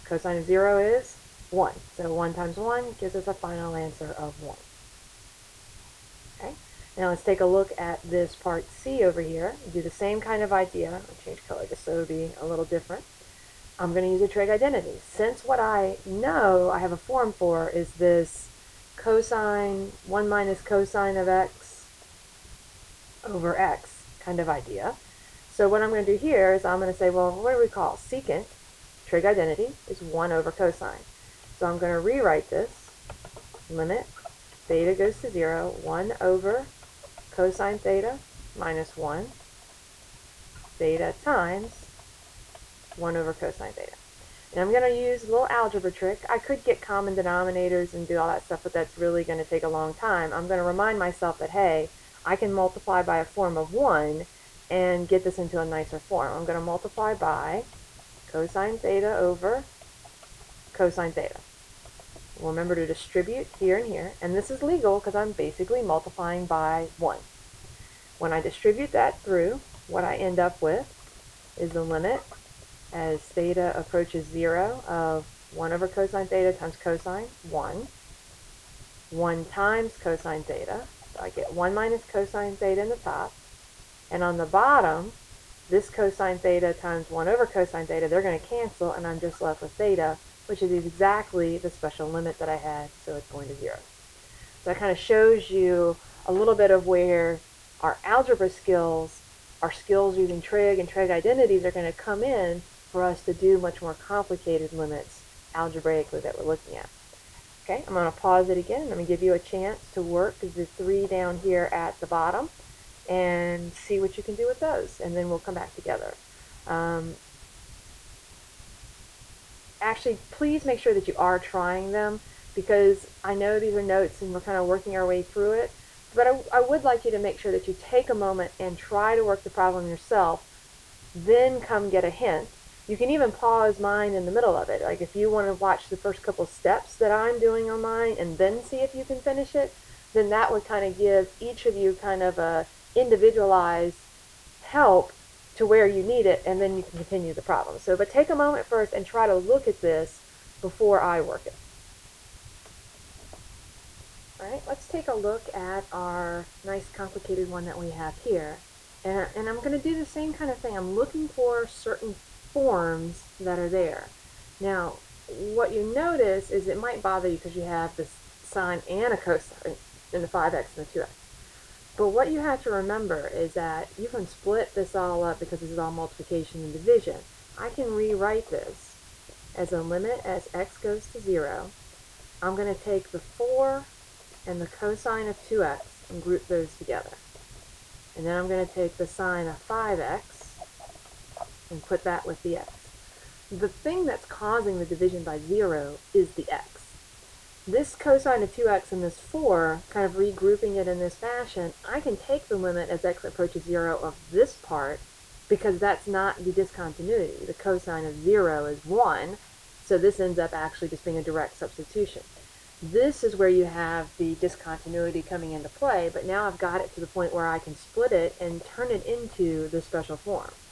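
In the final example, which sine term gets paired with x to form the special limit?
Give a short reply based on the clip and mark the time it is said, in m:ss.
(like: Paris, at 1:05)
sine of 5x, at 3:09.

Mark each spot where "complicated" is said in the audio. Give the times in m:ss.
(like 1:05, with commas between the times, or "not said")
1:43, 2:36.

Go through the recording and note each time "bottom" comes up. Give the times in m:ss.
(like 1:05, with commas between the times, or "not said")
1:24, 1:52.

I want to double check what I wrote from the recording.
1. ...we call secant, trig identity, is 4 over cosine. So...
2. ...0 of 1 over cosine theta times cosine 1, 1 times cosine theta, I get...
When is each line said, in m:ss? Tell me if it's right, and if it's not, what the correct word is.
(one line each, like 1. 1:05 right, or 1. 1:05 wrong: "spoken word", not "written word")
1. 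0:27 wrong: "1", not "4"
2. 1:14 right.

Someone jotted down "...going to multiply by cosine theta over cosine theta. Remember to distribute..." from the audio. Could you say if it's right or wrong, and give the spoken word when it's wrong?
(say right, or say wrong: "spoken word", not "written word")
right.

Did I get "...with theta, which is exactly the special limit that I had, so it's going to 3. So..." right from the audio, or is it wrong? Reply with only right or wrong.
wrong.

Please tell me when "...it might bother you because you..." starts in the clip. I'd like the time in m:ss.
2:46.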